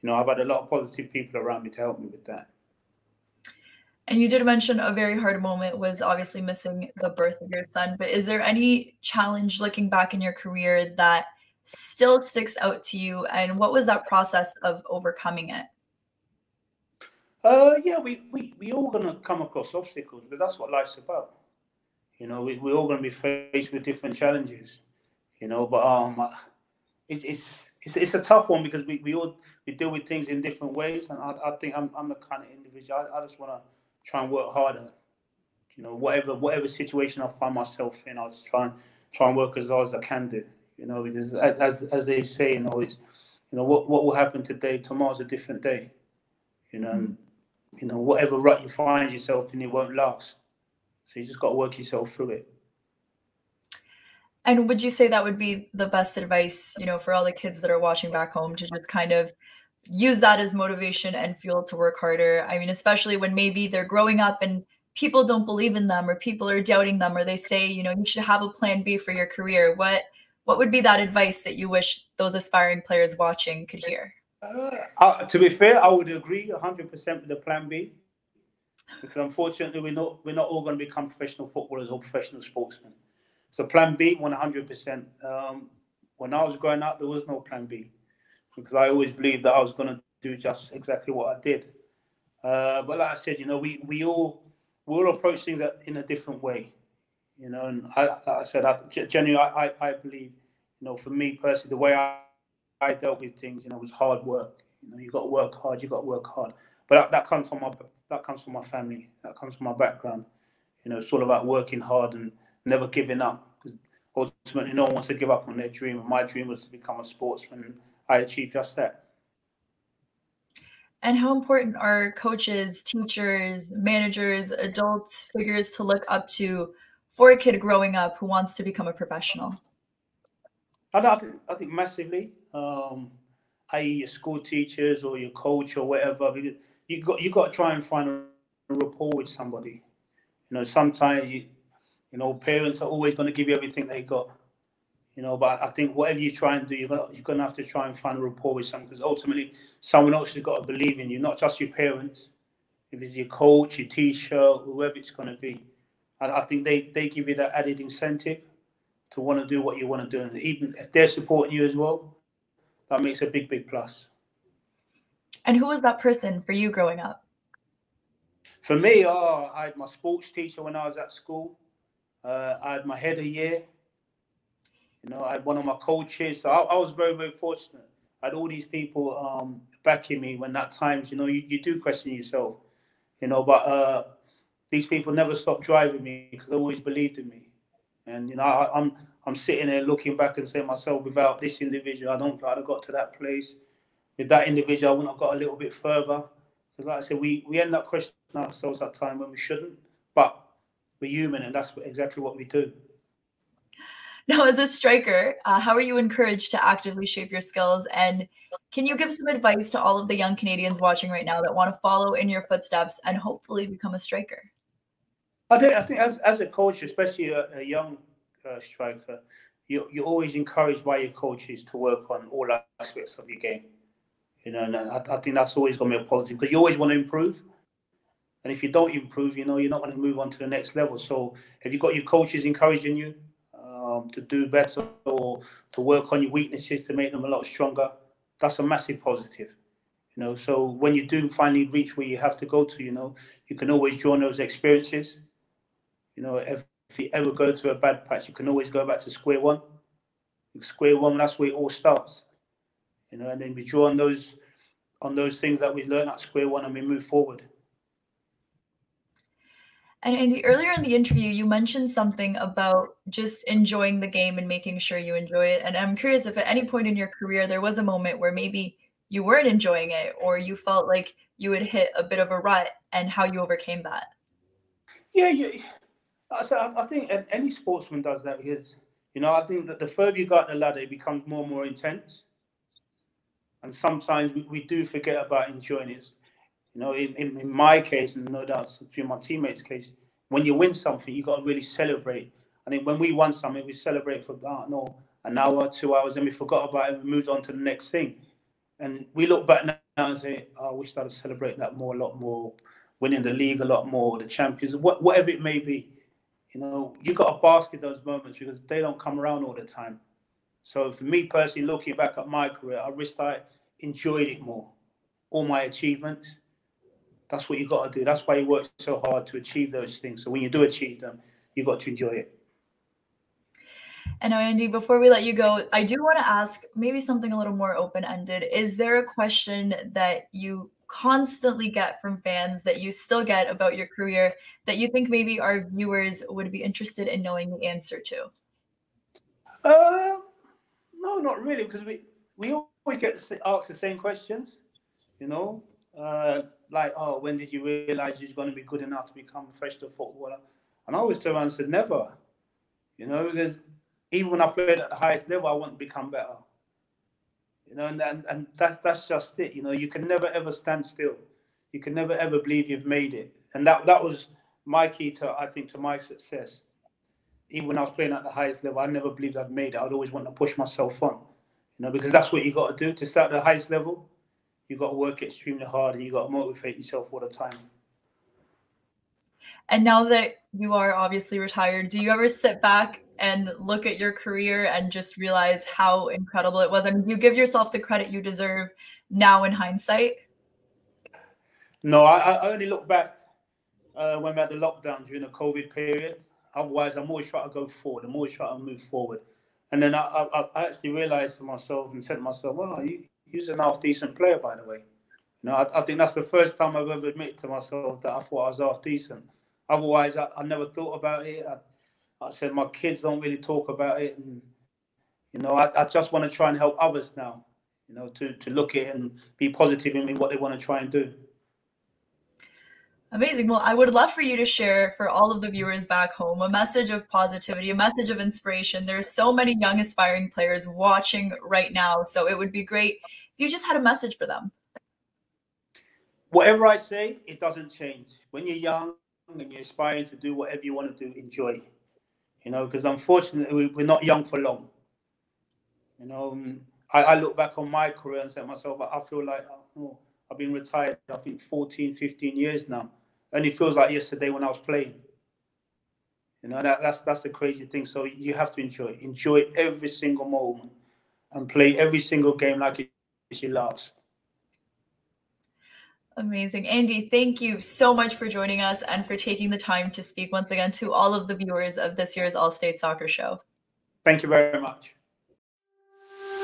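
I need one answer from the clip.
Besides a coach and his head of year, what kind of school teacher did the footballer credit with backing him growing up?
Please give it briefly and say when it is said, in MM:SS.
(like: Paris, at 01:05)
sports teacher, at 02:49.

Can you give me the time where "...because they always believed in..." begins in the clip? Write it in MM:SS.
03:06.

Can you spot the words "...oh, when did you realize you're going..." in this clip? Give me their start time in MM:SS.
05:46.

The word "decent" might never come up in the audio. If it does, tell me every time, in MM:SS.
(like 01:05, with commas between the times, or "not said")
06:43, 06:48.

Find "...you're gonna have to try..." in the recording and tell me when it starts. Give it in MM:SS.
02:27.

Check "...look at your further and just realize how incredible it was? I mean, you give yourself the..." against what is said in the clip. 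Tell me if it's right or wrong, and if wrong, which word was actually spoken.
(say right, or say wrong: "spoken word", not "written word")
wrong: "career", not "further".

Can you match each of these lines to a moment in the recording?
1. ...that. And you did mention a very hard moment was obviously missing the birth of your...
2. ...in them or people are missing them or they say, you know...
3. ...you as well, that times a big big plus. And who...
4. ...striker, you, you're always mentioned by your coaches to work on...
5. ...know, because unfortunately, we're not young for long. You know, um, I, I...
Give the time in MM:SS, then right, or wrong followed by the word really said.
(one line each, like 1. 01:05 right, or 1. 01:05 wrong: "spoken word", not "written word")
1. 00:02 right
2. 01:05 wrong: "doubting", not "missing"
3. 02:41 wrong: "makes", not "times"
4. 03:38 wrong: "encouraged", not "mentioned"
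5. 07:22 right.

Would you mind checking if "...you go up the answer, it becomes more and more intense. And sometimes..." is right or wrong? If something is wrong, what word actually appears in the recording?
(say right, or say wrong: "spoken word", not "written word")
wrong: "ladder", not "answer".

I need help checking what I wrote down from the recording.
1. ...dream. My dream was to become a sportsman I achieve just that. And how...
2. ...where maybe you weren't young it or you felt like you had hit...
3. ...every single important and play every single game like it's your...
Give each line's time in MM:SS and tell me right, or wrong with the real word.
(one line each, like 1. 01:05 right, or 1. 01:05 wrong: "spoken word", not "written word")
1. 01:55 right
2. 04:28 wrong: "enjoying", not "young"
3. 07:39 wrong: "moment", not "important".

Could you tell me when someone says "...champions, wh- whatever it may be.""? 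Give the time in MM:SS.
05:04.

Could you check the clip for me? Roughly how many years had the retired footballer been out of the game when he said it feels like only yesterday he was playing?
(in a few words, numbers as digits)
14, 15 years.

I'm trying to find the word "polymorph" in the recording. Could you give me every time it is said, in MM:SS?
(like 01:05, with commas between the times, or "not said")
not said.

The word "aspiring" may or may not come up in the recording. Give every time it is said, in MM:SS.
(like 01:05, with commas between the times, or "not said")
01:12, 07:09, 07:19.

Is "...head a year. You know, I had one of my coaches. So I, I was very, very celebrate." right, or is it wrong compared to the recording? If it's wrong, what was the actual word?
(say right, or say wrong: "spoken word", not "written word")
wrong: "fortunate", not "celebrate".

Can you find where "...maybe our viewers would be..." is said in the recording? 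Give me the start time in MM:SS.
05:35.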